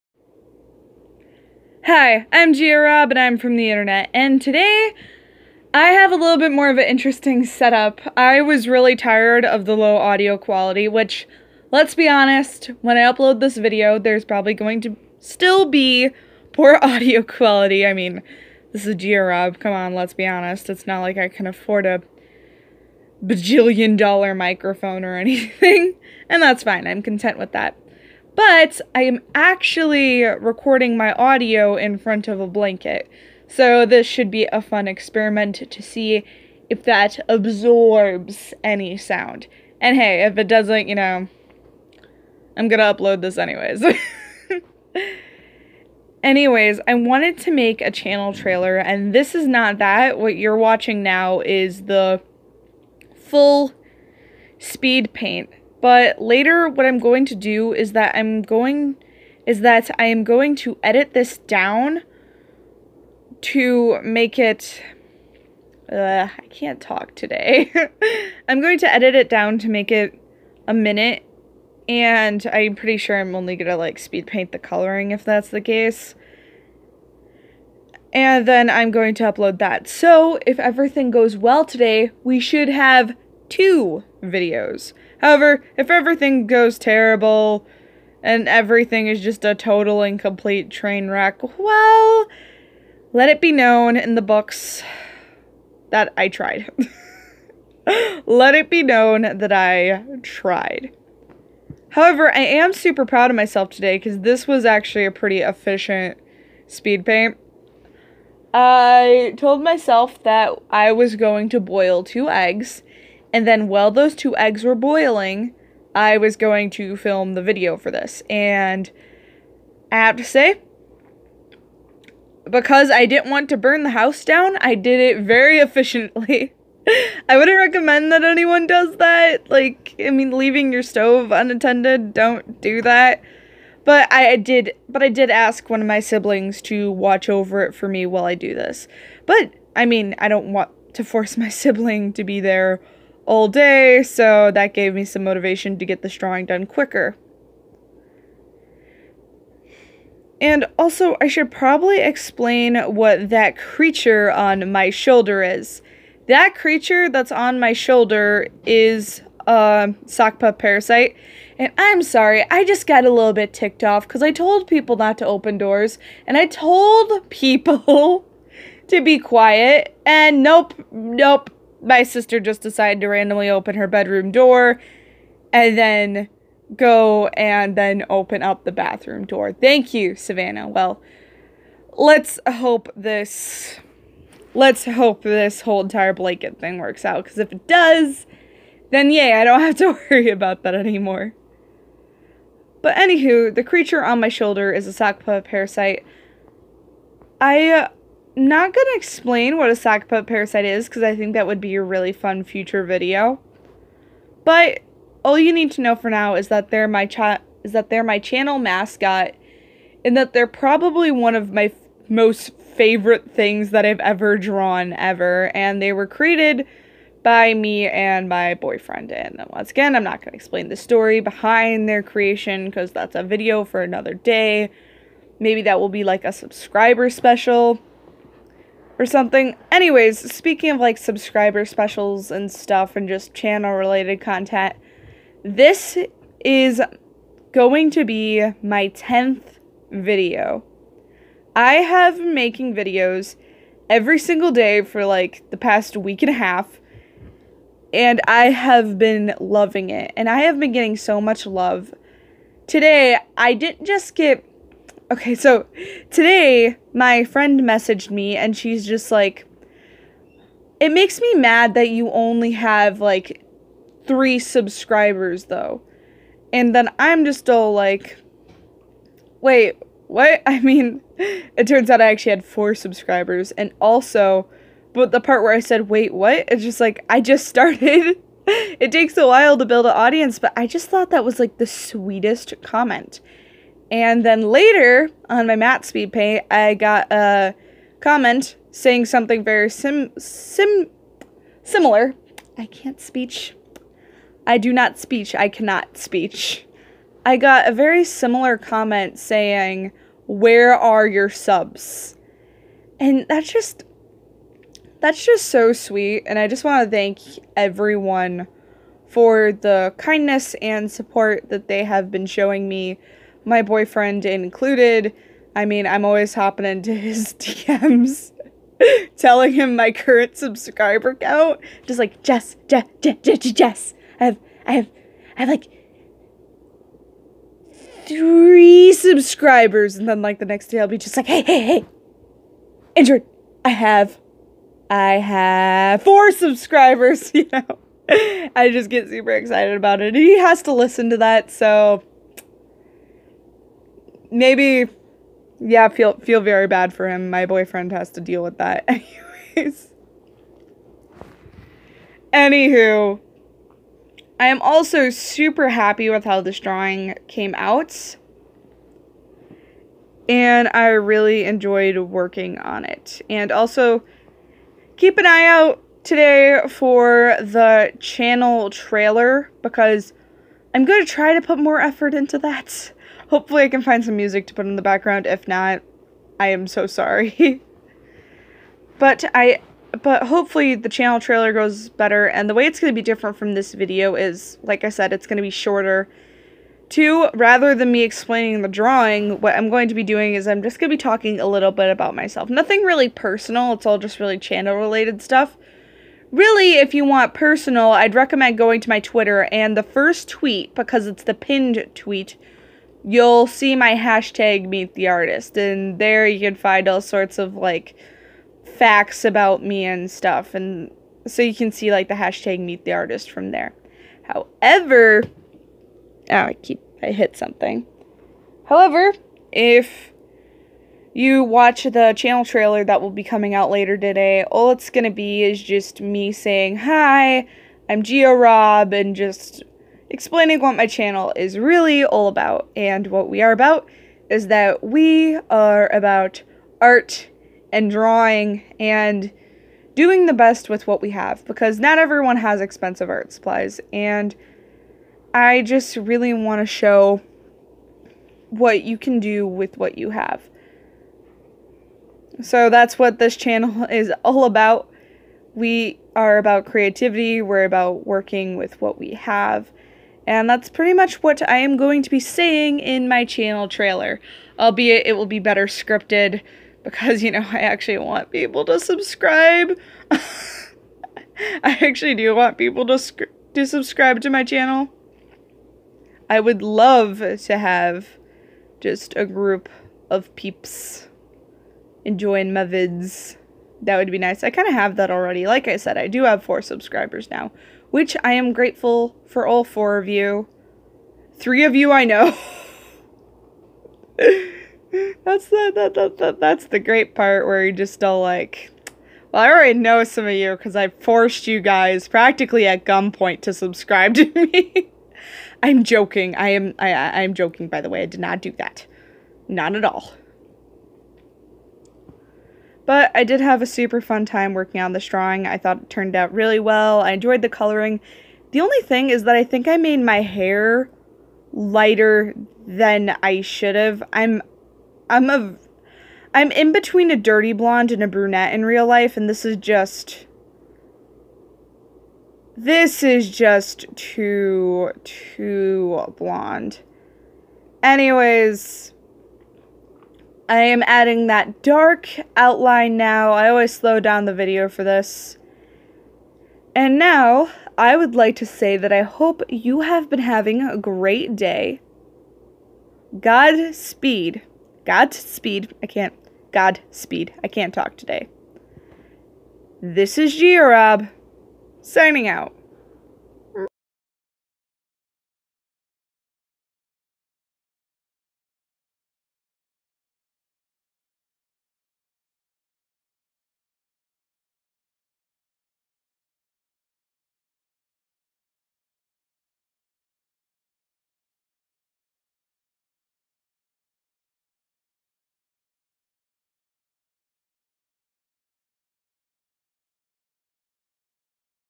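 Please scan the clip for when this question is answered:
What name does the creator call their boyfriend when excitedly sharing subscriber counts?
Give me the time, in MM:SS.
05:32.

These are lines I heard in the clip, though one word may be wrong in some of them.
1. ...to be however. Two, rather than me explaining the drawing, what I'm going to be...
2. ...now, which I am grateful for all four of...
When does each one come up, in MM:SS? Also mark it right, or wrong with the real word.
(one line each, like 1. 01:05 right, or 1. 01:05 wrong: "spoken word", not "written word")
1. 06:25 wrong: "shorter", not "however"
2. 08:07 right.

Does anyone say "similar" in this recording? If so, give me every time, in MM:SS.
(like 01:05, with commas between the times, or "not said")
04:51, 04:58.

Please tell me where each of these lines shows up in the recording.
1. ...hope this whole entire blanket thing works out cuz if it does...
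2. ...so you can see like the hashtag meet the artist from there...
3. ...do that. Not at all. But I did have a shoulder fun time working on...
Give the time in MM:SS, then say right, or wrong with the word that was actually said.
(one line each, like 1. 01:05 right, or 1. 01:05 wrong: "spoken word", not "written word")
1. 03:04 right
2. 06:51 right
3. 08:28 wrong: "super", not "shoulder".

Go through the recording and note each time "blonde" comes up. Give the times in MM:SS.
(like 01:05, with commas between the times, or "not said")
08:47, 08:56.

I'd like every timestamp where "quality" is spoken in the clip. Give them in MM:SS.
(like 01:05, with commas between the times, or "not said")
00:10, 00:17.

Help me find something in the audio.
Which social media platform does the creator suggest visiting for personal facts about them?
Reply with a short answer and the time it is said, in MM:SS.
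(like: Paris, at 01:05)
Twitter, at 06:38.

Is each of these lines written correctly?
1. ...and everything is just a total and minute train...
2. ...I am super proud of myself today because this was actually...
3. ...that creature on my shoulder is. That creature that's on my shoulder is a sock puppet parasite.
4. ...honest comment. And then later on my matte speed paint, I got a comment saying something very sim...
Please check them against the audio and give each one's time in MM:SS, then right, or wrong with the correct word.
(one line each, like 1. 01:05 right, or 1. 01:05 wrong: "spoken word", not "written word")
1. 01:28 wrong: "complete", not "minute"
2. 01:42 right
3. 02:33 right
4. 04:41 wrong: "sweetest", not "honest".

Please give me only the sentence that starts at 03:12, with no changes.
But anywho, the creature on my shoulder is a sock parasite.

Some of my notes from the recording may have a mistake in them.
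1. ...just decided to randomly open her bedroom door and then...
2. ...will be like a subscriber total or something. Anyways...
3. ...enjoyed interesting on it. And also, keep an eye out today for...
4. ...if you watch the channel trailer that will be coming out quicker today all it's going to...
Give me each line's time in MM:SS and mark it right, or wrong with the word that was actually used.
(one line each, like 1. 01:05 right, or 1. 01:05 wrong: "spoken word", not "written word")
1. 02:52 right
2. 03:45 wrong: "special", not "total"
3. 06:01 wrong: "working", not "interesting"
4. 06:59 wrong: "later", not "quicker".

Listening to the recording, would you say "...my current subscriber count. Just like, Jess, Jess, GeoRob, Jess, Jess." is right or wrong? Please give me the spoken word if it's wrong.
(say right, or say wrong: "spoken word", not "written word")
wrong: "Jess", not "GeoRob".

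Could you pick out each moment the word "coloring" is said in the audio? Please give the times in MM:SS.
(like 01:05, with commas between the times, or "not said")
01:14, 08:37.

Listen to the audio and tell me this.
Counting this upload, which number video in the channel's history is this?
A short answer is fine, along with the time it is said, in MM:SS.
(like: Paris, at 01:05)
10th, at 03:58.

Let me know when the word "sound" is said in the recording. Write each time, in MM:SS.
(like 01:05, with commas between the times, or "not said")
00:38.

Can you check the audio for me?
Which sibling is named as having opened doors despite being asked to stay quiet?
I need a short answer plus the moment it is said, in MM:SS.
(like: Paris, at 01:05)
Savannah, at 03:00.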